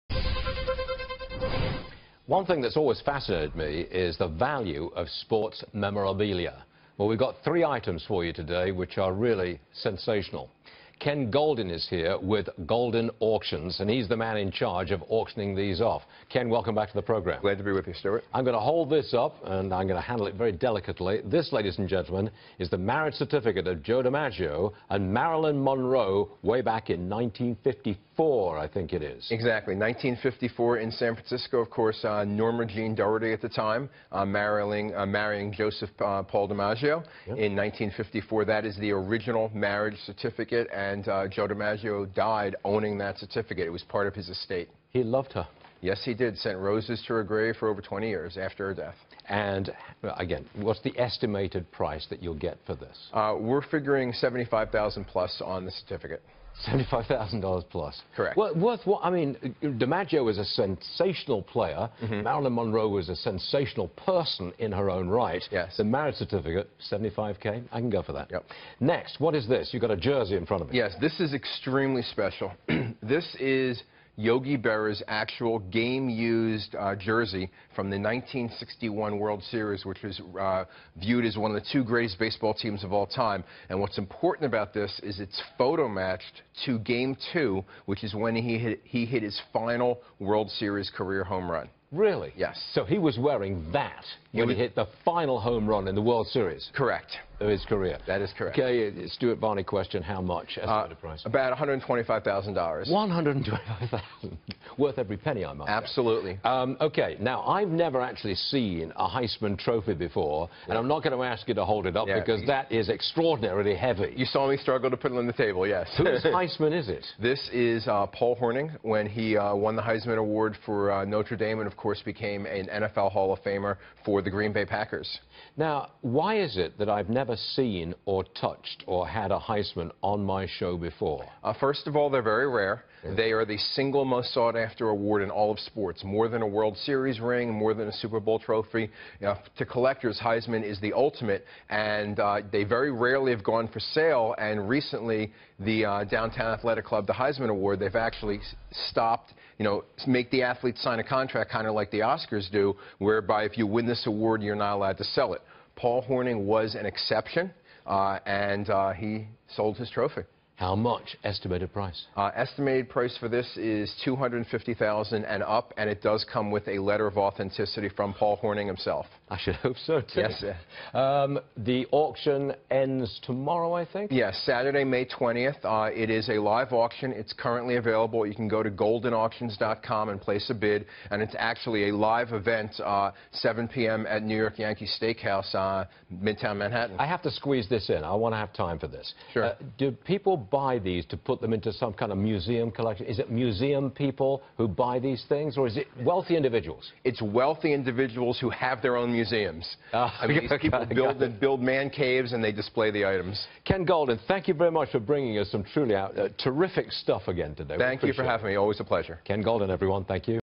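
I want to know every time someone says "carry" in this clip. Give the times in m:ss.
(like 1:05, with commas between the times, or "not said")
not said.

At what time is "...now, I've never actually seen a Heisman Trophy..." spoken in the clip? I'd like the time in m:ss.
1:47.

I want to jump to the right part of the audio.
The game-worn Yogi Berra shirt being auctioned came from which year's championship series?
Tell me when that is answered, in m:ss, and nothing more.
1:17.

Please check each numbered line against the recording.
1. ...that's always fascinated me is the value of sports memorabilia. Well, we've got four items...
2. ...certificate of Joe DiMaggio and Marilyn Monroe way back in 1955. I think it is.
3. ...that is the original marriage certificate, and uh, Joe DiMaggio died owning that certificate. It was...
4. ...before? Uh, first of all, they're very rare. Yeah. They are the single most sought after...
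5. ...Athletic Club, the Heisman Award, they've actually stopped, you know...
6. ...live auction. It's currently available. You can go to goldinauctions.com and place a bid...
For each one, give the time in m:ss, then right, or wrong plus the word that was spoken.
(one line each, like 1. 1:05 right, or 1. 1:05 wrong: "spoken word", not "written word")
1. 0:02 wrong: "three", not "four"
2. 0:23 right
3. 0:38 right
4. 2:10 right
5. 2:26 right
6. 2:56 right.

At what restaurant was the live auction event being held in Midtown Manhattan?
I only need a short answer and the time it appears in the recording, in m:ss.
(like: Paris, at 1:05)
New York Yankee Steakhouse, at 3:04.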